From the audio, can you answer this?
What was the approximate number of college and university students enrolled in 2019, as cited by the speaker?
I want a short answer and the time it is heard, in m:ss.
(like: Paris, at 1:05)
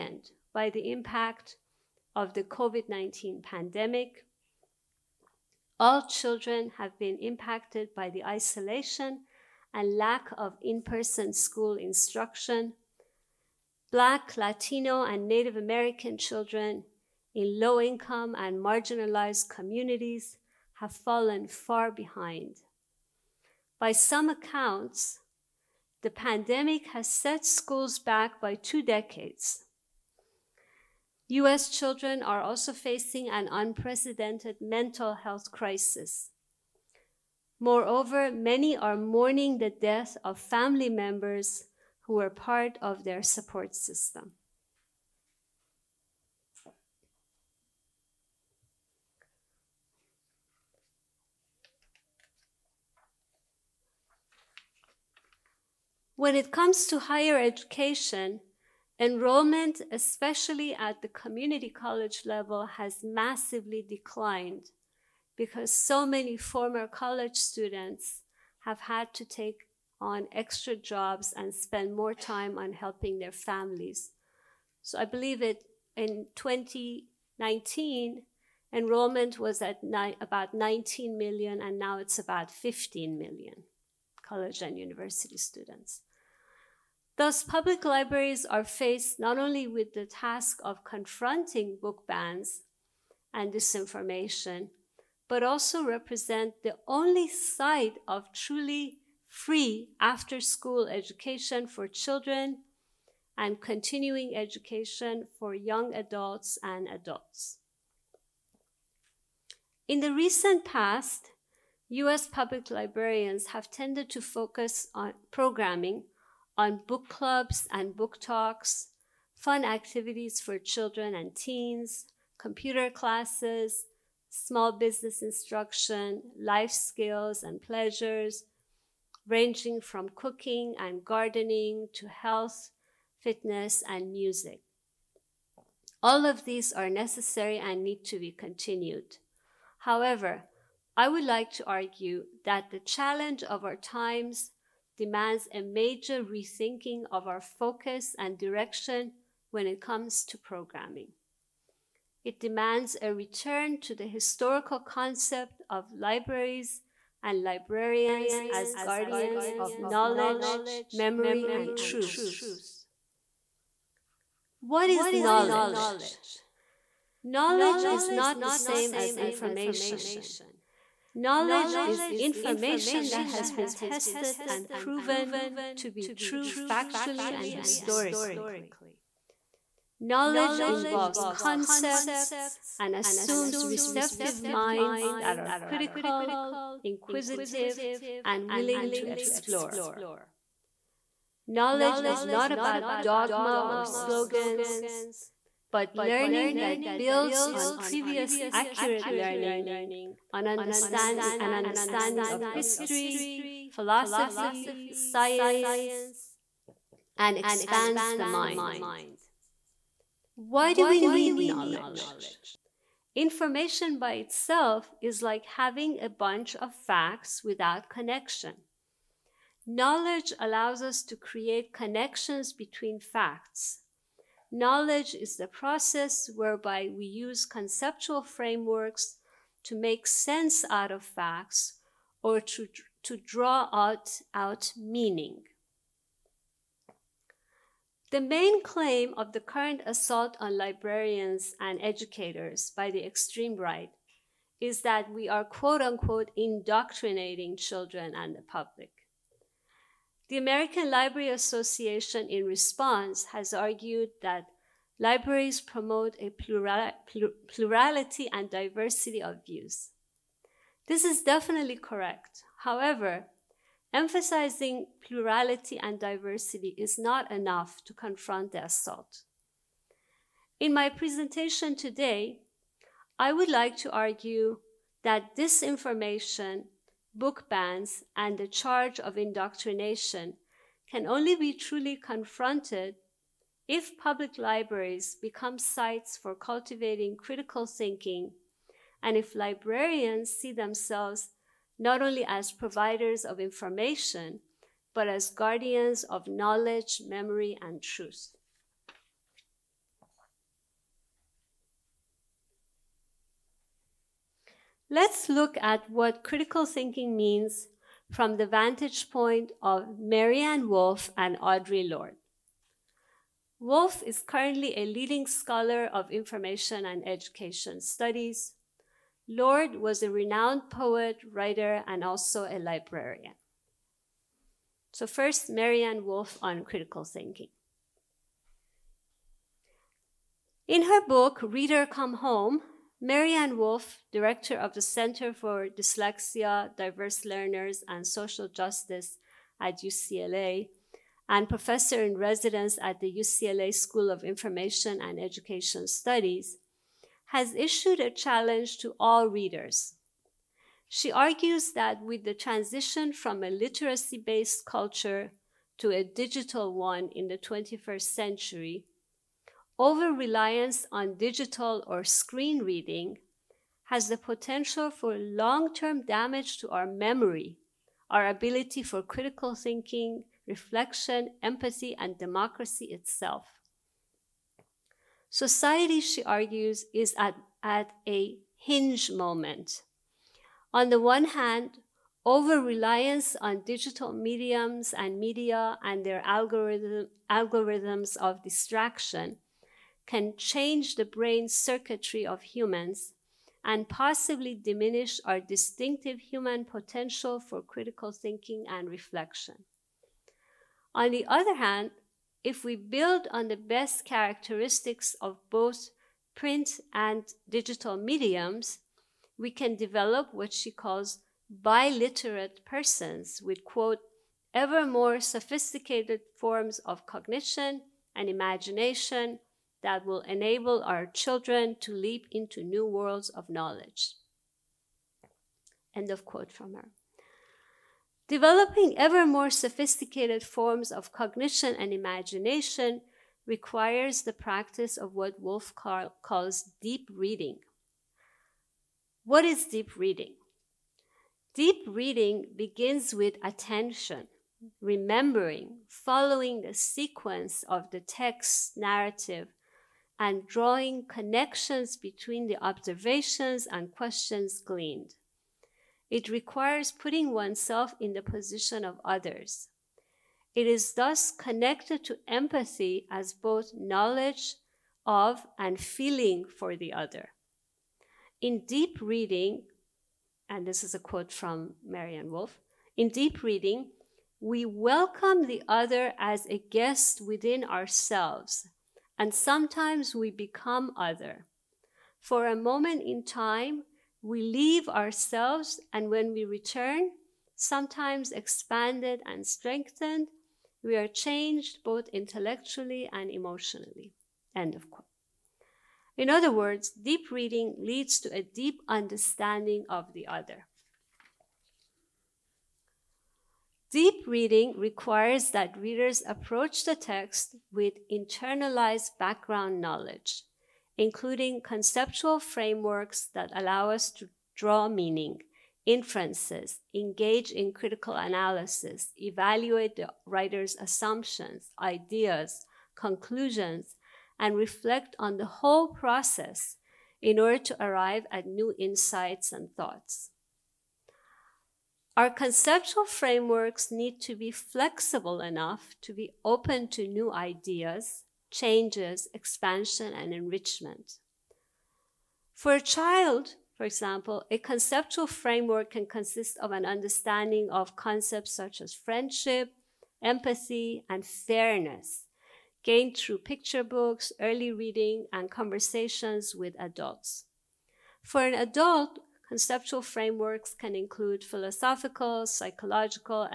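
19 million, at 1:20.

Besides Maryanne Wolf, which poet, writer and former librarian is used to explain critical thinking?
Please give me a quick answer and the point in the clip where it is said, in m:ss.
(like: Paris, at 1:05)
Audre Lorde, at 5:11.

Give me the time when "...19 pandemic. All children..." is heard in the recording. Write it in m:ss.
0:02.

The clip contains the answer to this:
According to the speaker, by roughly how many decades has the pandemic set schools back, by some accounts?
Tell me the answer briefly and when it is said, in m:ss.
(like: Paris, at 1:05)
2 decades, at 0:28.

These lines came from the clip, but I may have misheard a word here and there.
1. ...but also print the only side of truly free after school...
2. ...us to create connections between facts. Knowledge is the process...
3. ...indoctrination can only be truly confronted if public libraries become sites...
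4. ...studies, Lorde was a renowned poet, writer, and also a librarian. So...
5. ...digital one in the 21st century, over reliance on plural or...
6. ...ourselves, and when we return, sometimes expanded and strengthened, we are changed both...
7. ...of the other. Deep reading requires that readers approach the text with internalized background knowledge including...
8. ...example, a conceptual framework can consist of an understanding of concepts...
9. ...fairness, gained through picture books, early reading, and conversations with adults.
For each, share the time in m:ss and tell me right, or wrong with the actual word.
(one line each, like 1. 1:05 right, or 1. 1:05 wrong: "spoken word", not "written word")
1. 1:35 wrong: "represent", not "print"
2. 3:40 right
3. 4:39 right
4. 5:17 right
5. 5:56 wrong: "digital", not "plural"
6. 8:04 right
7. 8:19 right
8. 9:03 right
9. 9:11 right.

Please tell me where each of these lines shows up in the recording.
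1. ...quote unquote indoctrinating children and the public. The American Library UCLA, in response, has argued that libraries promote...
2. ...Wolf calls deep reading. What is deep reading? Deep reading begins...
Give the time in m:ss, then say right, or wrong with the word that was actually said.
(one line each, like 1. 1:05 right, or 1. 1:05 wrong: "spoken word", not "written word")
1. 4:05 wrong: "Association", not "UCLA"
2. 7:15 right.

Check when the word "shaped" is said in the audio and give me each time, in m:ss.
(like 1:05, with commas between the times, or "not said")
not said.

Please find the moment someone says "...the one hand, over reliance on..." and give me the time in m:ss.
6:20.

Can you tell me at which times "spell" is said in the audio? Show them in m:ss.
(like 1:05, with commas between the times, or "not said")
not said.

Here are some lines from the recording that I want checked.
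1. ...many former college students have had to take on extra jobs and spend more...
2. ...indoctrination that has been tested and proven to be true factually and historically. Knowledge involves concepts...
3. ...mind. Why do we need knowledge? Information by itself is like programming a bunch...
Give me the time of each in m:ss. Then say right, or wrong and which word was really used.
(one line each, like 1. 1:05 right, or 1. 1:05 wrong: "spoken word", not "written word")
1. 1:06 right
2. 2:52 wrong: "information", not "indoctrination"
3. 3:28 wrong: "having", not "programming".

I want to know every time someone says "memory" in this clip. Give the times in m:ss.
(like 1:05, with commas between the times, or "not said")
2:40, 4:57, 6:06.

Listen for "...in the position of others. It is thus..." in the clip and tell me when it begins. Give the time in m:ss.
7:37.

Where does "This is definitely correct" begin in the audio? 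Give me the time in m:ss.
4:20.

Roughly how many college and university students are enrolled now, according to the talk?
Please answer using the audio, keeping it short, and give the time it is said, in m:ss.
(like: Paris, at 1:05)
15 million, at 1:22.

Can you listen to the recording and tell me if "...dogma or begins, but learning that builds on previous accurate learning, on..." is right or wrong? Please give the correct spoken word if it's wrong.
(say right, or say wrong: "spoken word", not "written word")
wrong: "slogans", not "begins".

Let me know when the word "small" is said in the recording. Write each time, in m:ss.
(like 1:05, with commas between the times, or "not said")
2:04.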